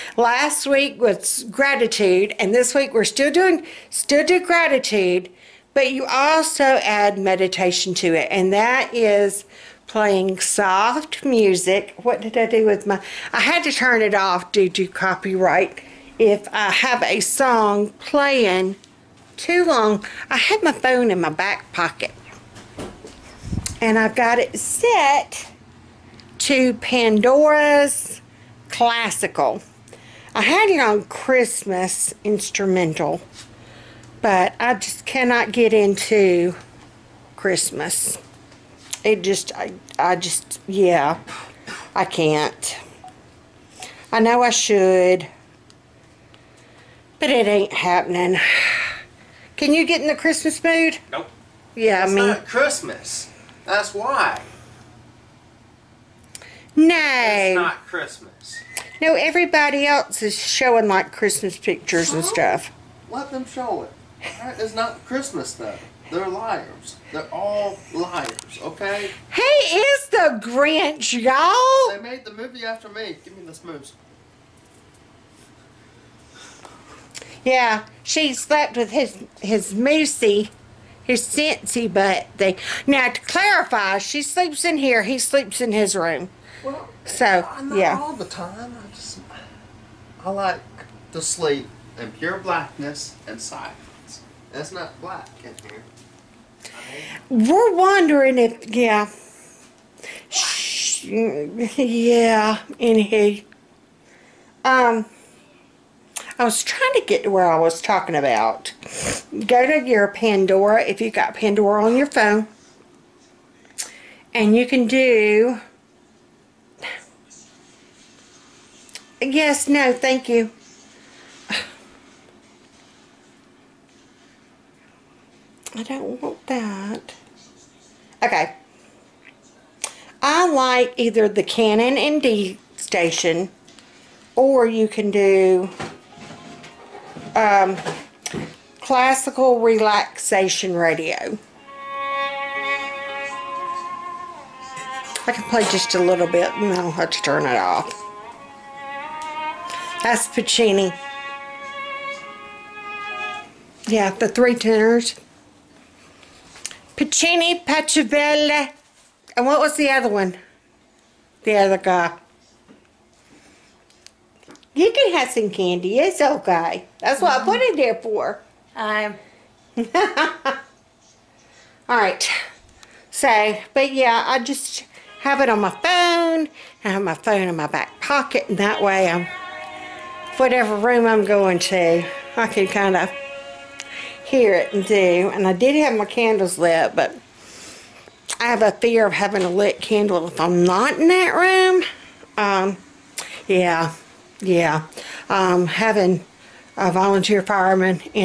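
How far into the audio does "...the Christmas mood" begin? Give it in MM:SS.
00:50.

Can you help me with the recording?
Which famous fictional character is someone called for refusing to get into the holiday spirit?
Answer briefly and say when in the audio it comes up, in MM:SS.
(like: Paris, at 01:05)
The Grinch, at 01:10.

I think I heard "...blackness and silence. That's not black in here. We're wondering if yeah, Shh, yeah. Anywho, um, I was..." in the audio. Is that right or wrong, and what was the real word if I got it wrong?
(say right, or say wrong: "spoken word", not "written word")
right.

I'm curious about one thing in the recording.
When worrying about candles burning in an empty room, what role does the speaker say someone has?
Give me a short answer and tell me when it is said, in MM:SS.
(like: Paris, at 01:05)
volunteer fireman, at 03:16.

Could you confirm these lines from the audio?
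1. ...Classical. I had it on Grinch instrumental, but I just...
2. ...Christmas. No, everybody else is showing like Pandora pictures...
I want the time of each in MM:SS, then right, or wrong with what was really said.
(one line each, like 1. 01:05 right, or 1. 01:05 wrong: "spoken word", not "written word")
1. 00:28 wrong: "Christmas", not "Grinch"
2. 00:57 wrong: "Christmas", not "Pandora".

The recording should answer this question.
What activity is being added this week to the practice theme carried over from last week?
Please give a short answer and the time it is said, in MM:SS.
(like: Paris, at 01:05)
meditation, at 00:07.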